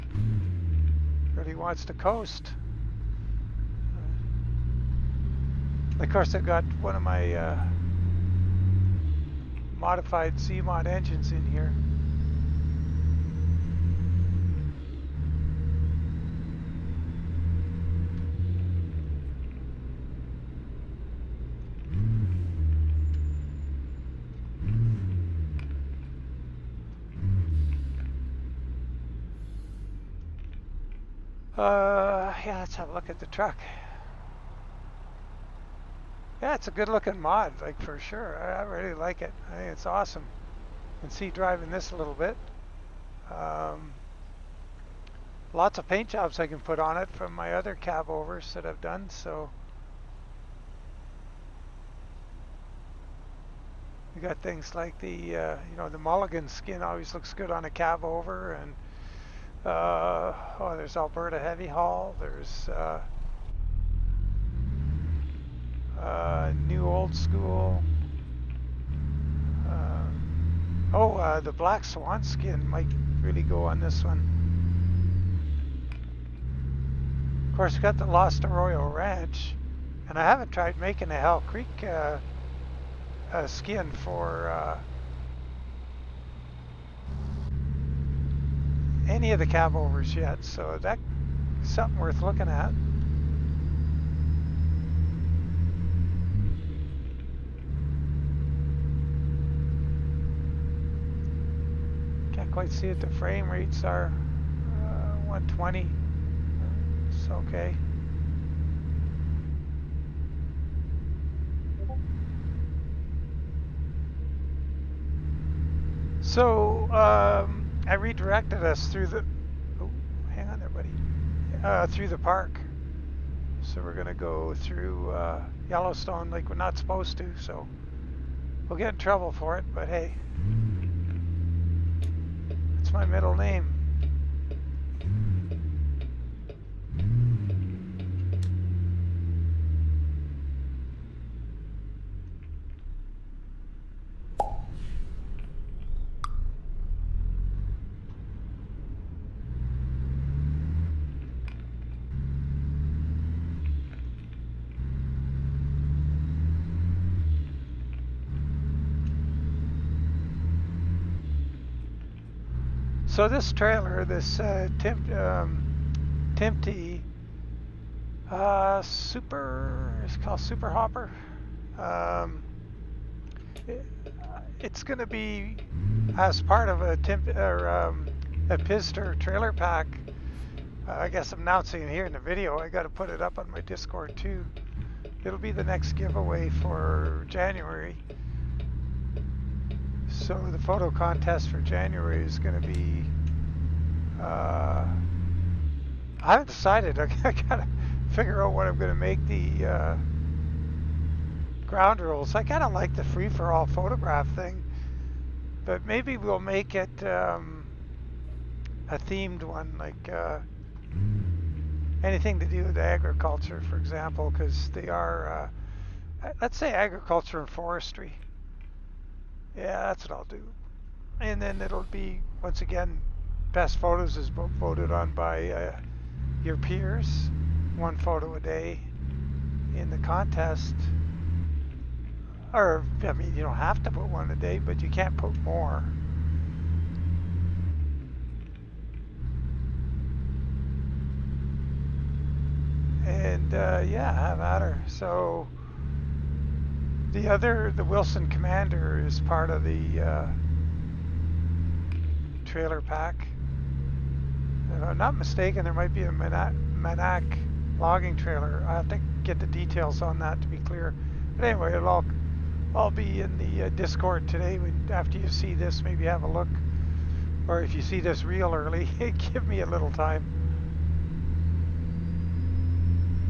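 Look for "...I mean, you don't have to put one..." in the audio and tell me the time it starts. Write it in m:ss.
3:53.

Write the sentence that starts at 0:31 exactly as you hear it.
Uh, yeah, let's have a look at the truck.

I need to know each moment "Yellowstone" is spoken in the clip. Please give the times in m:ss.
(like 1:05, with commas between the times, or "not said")
2:05.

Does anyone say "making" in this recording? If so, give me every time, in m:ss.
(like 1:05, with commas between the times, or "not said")
1:20.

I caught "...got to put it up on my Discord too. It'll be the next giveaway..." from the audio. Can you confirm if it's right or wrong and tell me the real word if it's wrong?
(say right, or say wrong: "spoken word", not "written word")
right.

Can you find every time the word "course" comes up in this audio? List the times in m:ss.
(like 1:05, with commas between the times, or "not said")
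0:06, 1:17.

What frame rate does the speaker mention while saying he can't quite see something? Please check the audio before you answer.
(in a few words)
120.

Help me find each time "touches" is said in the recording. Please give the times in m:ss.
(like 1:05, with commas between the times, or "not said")
not said.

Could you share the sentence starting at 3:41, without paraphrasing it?
And then it'll be, once again, best photos is voted on by uh, your peers.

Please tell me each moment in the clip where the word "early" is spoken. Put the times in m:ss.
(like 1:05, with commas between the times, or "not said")
4:28.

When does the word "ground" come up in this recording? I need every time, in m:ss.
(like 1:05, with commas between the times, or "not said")
3:21.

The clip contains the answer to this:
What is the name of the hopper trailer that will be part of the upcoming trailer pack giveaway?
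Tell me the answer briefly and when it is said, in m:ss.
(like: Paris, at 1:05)
Super Hopper, at 2:50.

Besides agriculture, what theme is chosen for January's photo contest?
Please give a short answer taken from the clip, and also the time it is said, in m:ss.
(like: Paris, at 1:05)
Forestry, at 3:37.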